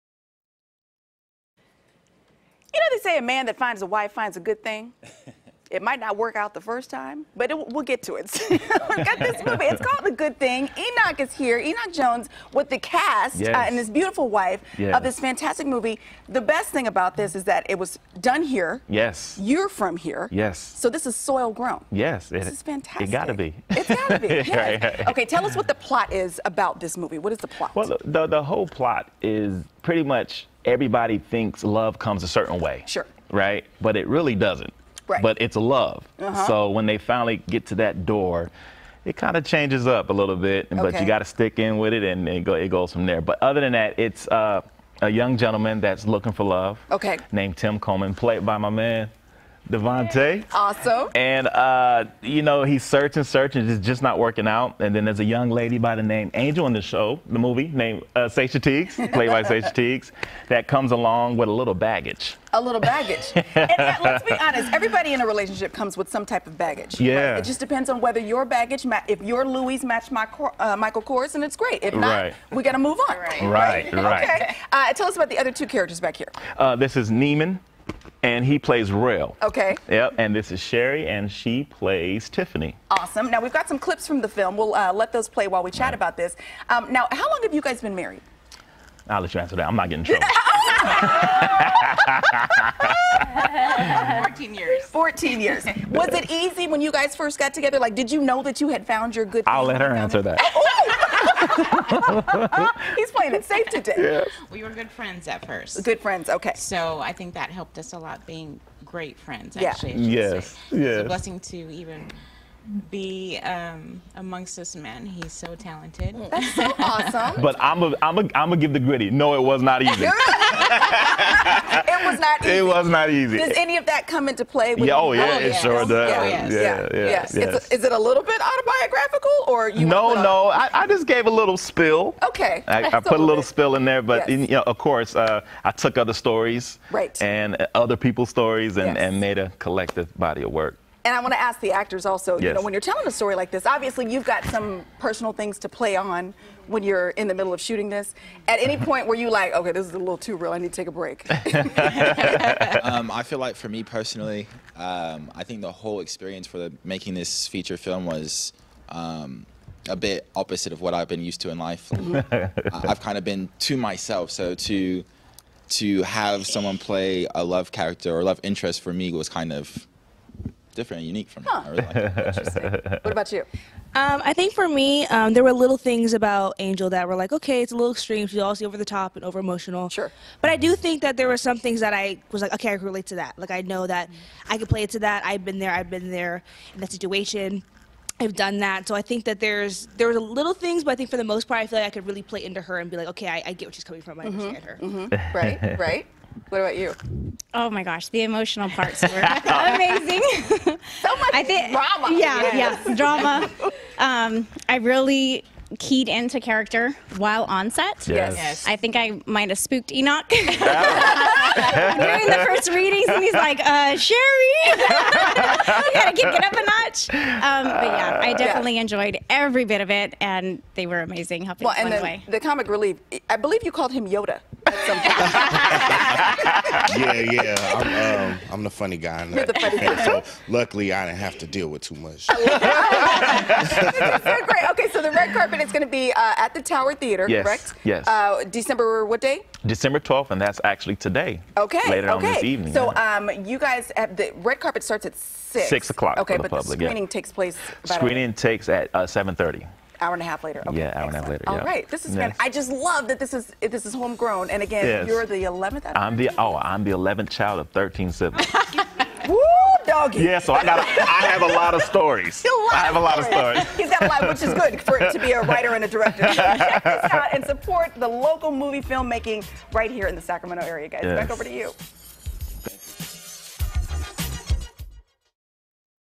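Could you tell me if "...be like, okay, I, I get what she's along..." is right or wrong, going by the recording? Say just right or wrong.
wrong.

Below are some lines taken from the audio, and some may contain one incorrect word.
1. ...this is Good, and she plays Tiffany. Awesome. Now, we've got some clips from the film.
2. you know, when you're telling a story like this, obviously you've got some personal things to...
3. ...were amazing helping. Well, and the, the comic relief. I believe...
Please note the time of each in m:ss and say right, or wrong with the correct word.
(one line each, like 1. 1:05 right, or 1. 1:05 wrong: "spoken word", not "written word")
1. 1:20 wrong: "Sherry", not "Good"
2. 2:22 right
3. 3:40 right.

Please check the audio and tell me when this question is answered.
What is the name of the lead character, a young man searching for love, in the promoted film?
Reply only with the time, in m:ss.
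0:47.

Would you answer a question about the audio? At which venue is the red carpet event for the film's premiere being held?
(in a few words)
Tower Theatre.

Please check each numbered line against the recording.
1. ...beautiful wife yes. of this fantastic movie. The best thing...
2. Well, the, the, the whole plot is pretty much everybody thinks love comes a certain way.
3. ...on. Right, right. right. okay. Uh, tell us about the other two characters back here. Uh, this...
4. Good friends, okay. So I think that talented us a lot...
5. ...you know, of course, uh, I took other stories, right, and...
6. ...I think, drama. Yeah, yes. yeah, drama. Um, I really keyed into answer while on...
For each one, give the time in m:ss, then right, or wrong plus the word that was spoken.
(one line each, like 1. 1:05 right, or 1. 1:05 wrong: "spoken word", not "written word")
1. 0:13 right
2. 0:27 right
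3. 1:13 right
4. 1:45 wrong: "helped", not "talented"
5. 2:14 right
6. 3:21 wrong: "character", not "answer".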